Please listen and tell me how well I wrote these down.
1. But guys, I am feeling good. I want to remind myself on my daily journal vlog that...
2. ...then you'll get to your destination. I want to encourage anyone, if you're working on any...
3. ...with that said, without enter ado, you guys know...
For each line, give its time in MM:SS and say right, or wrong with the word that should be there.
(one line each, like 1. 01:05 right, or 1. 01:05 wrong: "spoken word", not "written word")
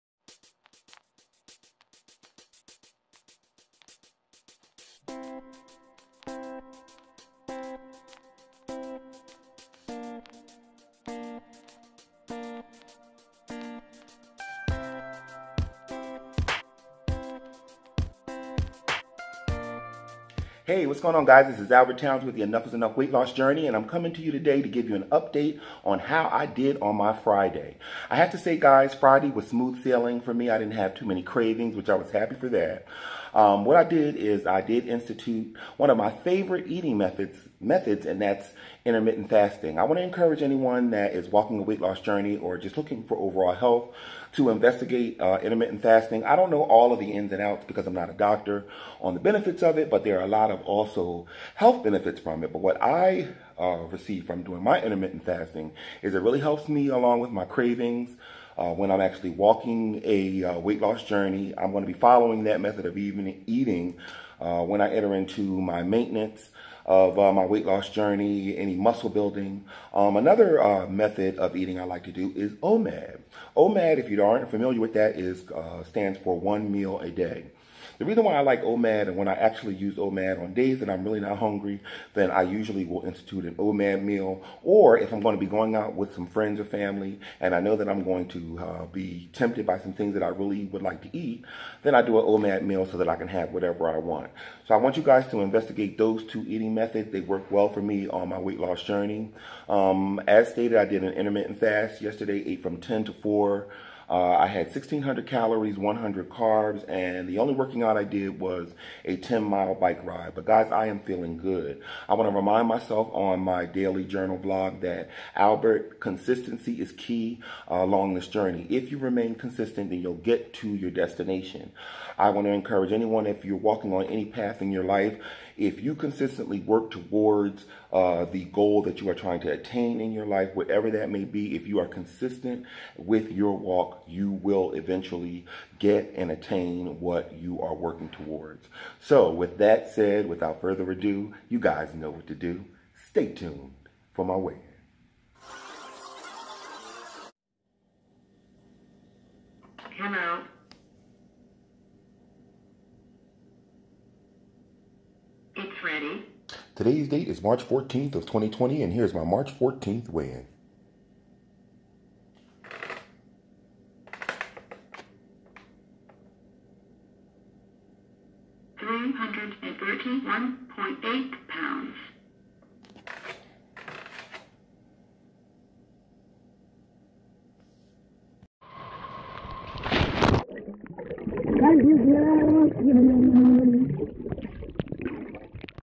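1. 01:50 right
2. 01:59 wrong: "walking", not "working"
3. 02:19 wrong: "further", not "enter".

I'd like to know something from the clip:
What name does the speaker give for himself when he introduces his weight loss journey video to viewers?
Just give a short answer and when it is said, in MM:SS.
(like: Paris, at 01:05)
Albert Towns, at 00:21.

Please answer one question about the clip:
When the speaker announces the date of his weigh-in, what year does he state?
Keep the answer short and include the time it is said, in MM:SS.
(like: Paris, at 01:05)
2020, at 02:38.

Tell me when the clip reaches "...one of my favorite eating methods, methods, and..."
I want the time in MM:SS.
00:35.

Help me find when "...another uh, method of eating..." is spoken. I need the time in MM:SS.
01:10.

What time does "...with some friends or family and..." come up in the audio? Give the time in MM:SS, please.
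01:25.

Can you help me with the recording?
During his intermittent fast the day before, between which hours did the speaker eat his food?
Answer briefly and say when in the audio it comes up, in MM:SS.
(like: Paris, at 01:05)
10 to 4, at 01:42.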